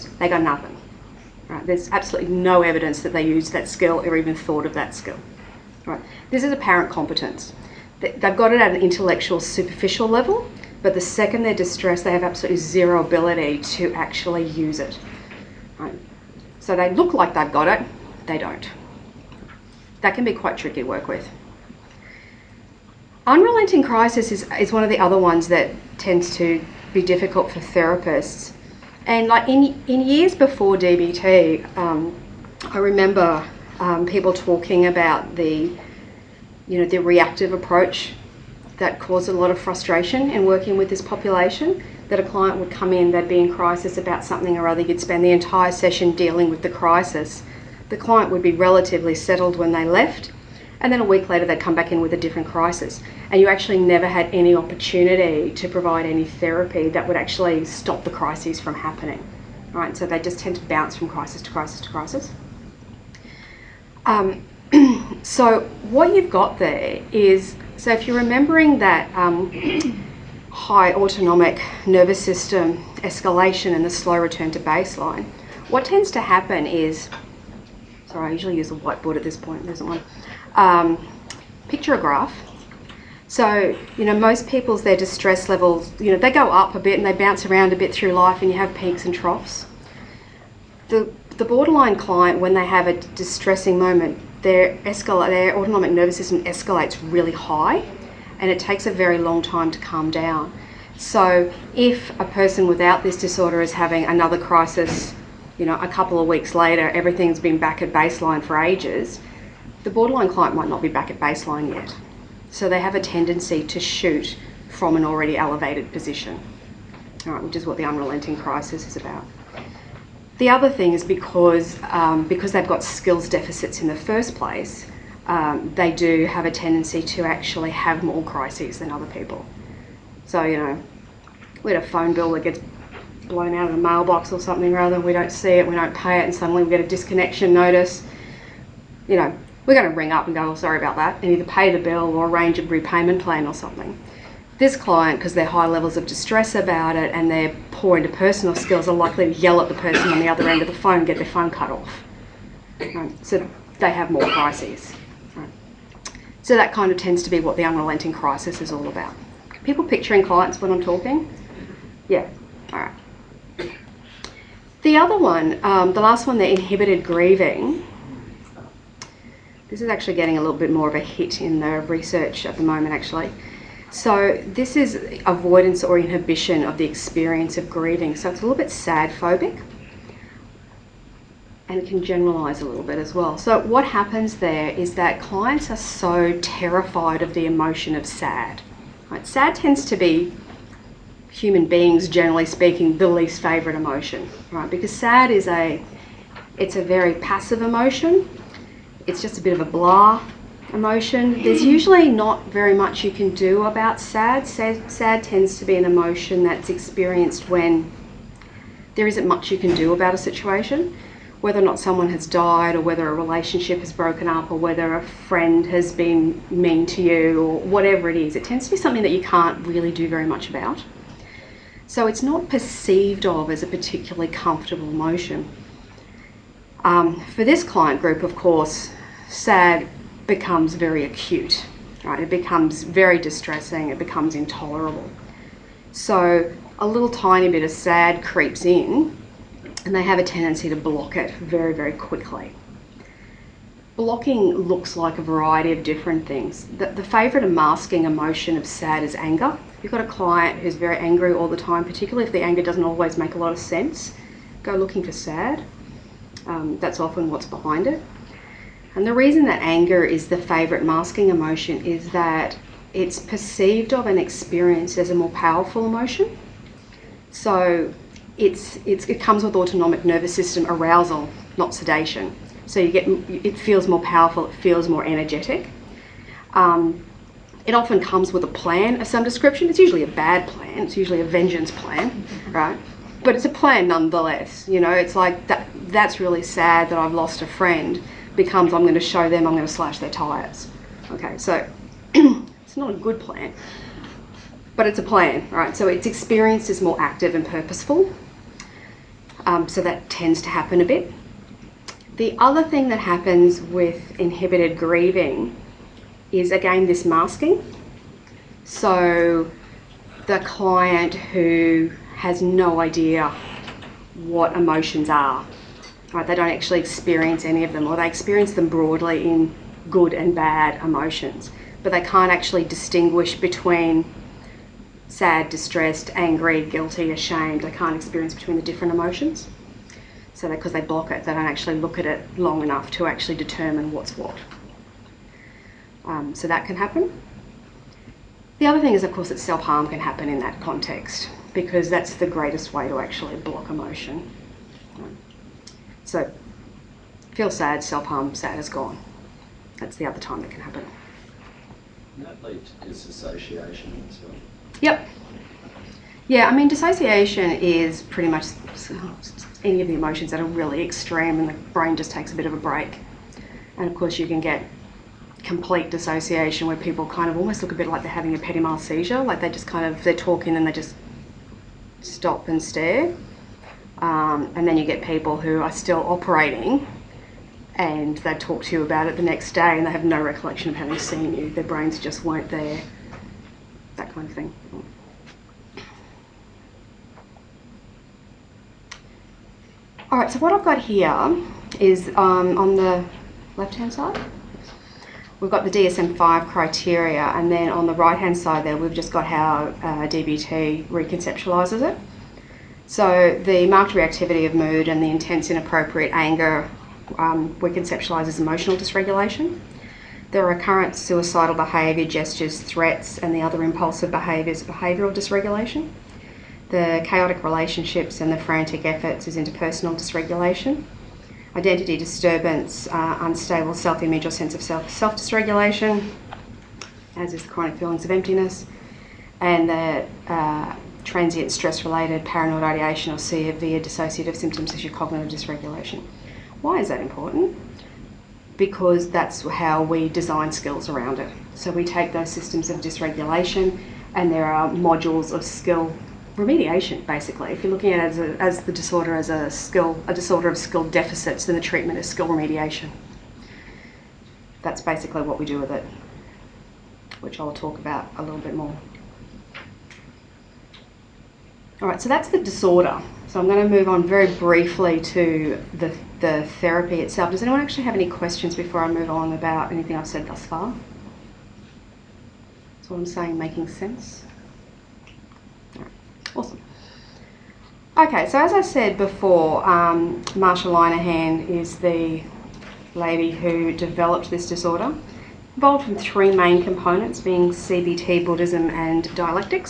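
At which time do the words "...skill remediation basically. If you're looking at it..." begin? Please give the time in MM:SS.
07:25.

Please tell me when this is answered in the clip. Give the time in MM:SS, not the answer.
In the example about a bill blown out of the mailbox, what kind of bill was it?
02:11.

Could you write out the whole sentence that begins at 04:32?
So you get, it feels more powerful, it feels more energetic.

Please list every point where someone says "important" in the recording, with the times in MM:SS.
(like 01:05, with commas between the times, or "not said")
07:17.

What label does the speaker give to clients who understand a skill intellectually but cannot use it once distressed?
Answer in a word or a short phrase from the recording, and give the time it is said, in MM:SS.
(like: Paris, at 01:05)
Apparent competence, at 00:06.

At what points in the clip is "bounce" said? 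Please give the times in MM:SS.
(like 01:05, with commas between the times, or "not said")
01:00, 01:27.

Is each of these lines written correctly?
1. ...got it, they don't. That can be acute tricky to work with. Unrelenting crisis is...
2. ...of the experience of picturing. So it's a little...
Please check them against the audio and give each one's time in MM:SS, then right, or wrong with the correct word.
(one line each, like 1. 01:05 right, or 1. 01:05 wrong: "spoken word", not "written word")
1. 00:17 wrong: "quite", not "acute"
2. 02:56 wrong: "grieving", not "picturing".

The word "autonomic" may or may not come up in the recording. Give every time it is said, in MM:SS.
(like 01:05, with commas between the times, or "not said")
01:10, 01:35, 04:29.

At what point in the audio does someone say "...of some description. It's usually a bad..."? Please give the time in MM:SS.
04:39.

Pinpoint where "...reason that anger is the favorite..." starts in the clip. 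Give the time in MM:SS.
04:19.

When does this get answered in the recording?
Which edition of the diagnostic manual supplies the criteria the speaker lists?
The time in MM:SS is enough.
06:35.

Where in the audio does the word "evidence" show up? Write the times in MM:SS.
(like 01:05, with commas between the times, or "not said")
00:02.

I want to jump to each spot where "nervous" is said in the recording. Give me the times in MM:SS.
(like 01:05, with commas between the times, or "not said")
01:11, 01:35, 04:30.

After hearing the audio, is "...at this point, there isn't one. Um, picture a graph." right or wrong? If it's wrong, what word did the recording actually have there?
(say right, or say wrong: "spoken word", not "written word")
right.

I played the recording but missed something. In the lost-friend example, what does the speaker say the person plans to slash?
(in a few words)
Their tyres.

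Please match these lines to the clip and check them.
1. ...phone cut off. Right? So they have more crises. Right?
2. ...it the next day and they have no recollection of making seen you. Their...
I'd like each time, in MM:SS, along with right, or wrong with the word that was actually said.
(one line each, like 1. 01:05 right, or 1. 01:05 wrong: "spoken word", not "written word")
1. 02:31 right
2. 06:19 wrong: "having", not "making".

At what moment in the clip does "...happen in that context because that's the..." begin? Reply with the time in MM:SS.
05:39.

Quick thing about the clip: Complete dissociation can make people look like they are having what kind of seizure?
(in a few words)
Petit mal seizure.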